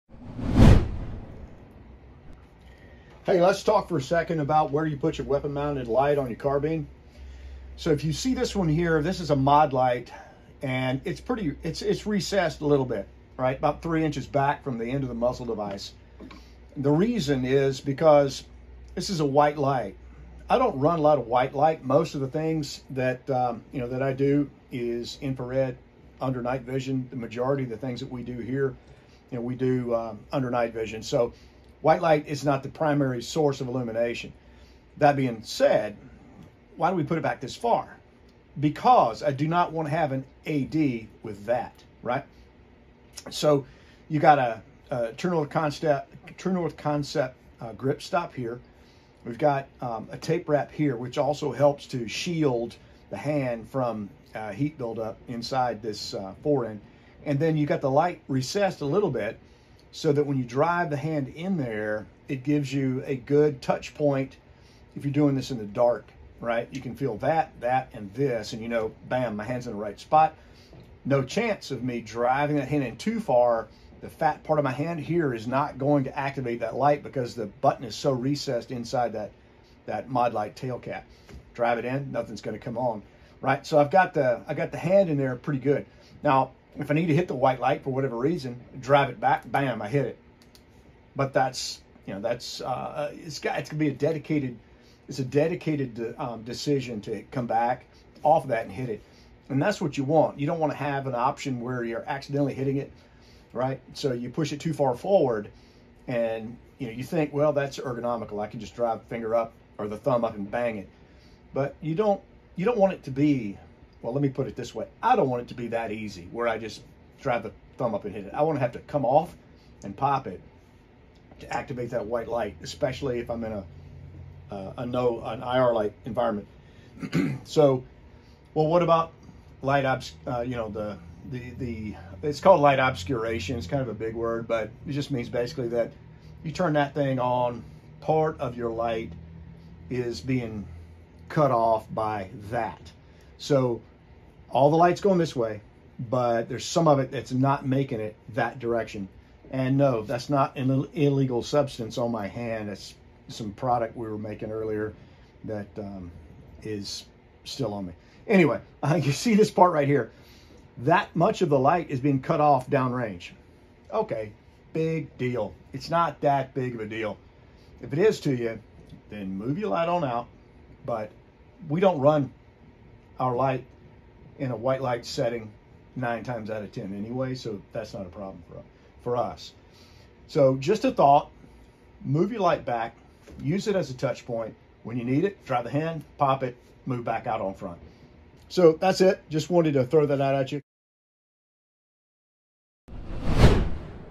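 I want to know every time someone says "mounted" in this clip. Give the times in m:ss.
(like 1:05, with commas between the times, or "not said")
0:05.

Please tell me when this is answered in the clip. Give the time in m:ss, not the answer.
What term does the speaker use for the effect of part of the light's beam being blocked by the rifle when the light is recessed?
2:12.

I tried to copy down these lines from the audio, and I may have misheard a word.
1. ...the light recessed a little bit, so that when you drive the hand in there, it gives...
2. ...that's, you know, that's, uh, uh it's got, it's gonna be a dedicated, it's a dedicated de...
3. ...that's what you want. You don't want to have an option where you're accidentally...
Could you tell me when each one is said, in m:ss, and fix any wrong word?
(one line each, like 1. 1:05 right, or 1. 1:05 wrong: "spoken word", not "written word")
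1. 0:57 right
2. 1:31 right
3. 1:39 right.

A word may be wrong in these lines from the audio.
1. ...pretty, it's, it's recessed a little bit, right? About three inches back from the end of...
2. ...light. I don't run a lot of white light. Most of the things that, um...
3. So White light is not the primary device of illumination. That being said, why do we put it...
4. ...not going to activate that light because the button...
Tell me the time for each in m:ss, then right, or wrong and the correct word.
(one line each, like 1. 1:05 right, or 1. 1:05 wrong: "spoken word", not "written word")
1. 0:11 right
2. 0:19 right
3. 0:31 wrong: "source", not "device"
4. 1:15 right.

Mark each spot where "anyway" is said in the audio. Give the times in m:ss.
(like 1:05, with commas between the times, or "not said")
2:38, 2:56.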